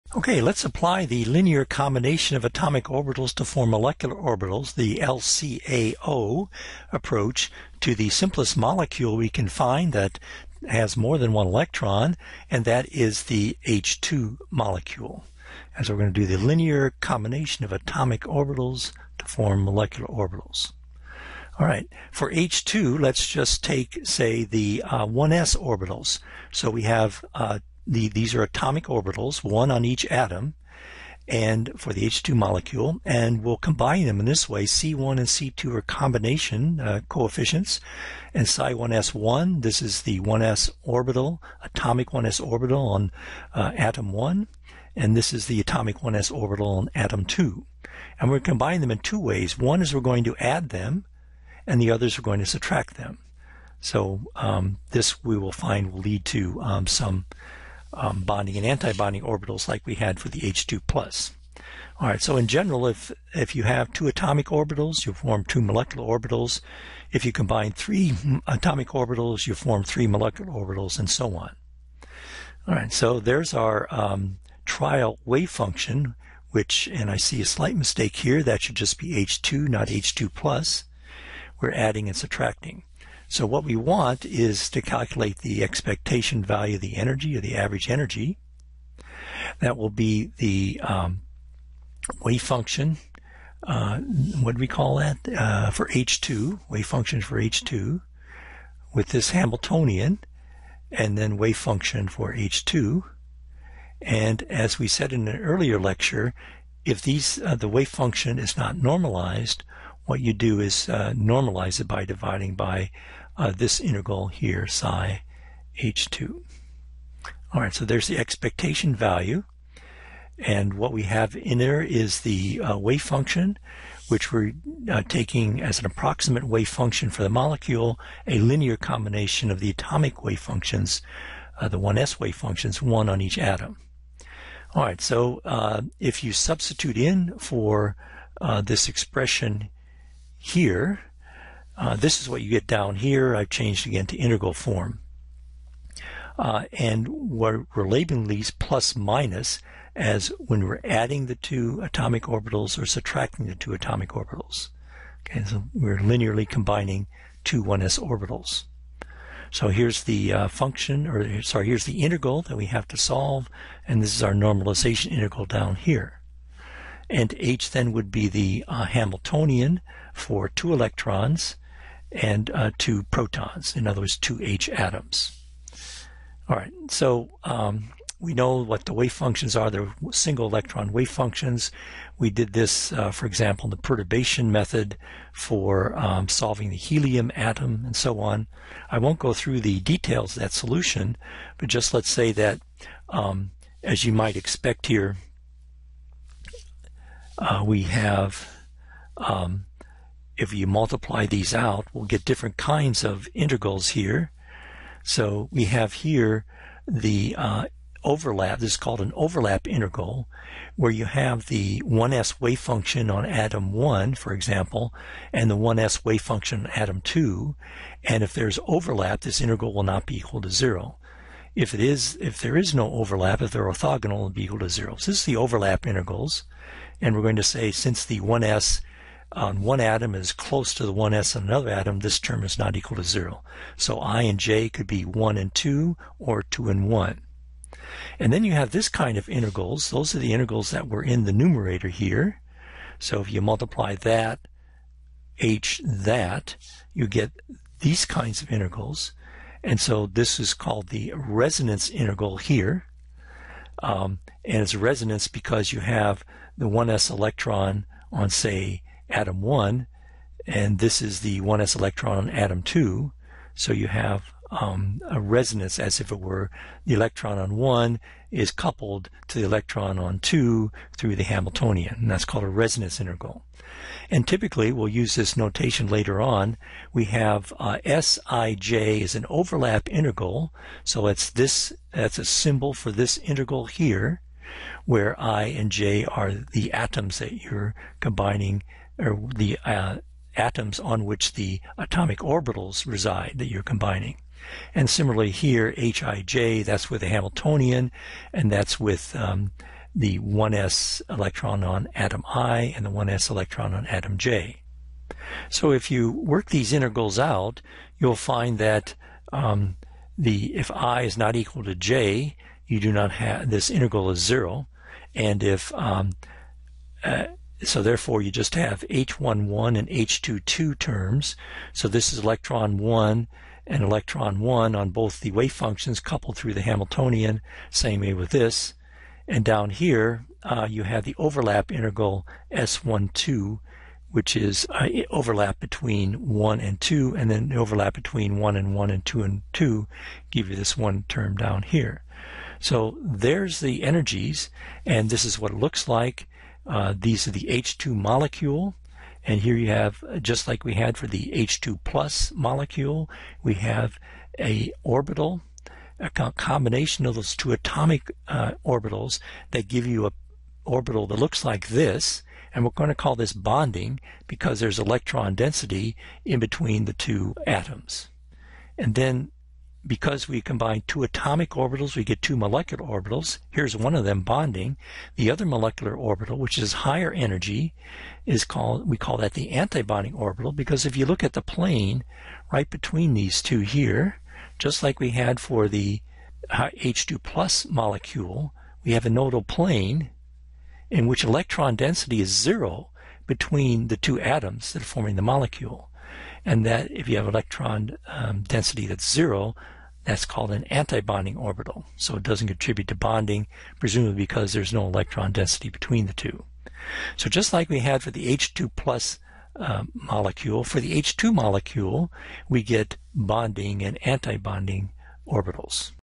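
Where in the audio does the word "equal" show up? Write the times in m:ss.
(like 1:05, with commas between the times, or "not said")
3:40, 3:44, 3:52, 5:11.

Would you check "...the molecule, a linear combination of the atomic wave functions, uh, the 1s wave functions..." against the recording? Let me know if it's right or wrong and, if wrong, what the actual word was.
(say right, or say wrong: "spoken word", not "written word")
right.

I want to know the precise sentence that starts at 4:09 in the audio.
And so this is called the resonance integral here.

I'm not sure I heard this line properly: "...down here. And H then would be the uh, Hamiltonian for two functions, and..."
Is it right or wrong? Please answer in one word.
wrong.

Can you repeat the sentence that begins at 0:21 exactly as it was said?
All right, for H2, let's just take, say, the uh, 1s orbitals.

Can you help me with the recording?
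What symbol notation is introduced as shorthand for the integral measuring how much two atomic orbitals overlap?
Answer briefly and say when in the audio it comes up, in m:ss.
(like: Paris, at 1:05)
Sij, at 4:37.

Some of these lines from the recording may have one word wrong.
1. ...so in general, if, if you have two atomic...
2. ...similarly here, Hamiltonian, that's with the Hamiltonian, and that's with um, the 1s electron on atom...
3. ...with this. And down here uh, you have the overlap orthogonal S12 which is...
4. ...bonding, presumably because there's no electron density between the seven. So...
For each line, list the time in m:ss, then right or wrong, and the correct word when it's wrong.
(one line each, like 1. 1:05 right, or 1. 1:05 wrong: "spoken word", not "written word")
1. 1:02 right
2. 4:54 wrong: "Hij", not "Hamiltonian"
3. 5:28 wrong: "integral", not "orthogonal"
4. 6:42 wrong: "two", not "seven".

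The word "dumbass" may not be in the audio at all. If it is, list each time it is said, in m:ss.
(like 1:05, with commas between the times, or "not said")
not said.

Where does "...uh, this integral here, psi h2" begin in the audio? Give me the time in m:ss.
1:53.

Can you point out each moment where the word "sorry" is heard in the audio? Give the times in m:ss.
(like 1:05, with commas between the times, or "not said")
2:41.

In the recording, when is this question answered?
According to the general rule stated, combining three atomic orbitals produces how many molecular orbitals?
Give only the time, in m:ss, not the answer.
1:09.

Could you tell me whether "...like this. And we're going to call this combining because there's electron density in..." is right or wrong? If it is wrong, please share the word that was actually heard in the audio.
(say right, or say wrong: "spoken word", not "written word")
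wrong: "bonding", not "combining".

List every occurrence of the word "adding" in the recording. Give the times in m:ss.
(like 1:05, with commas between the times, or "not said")
1:21, 2:30.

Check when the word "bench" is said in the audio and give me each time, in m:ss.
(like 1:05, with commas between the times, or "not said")
not said.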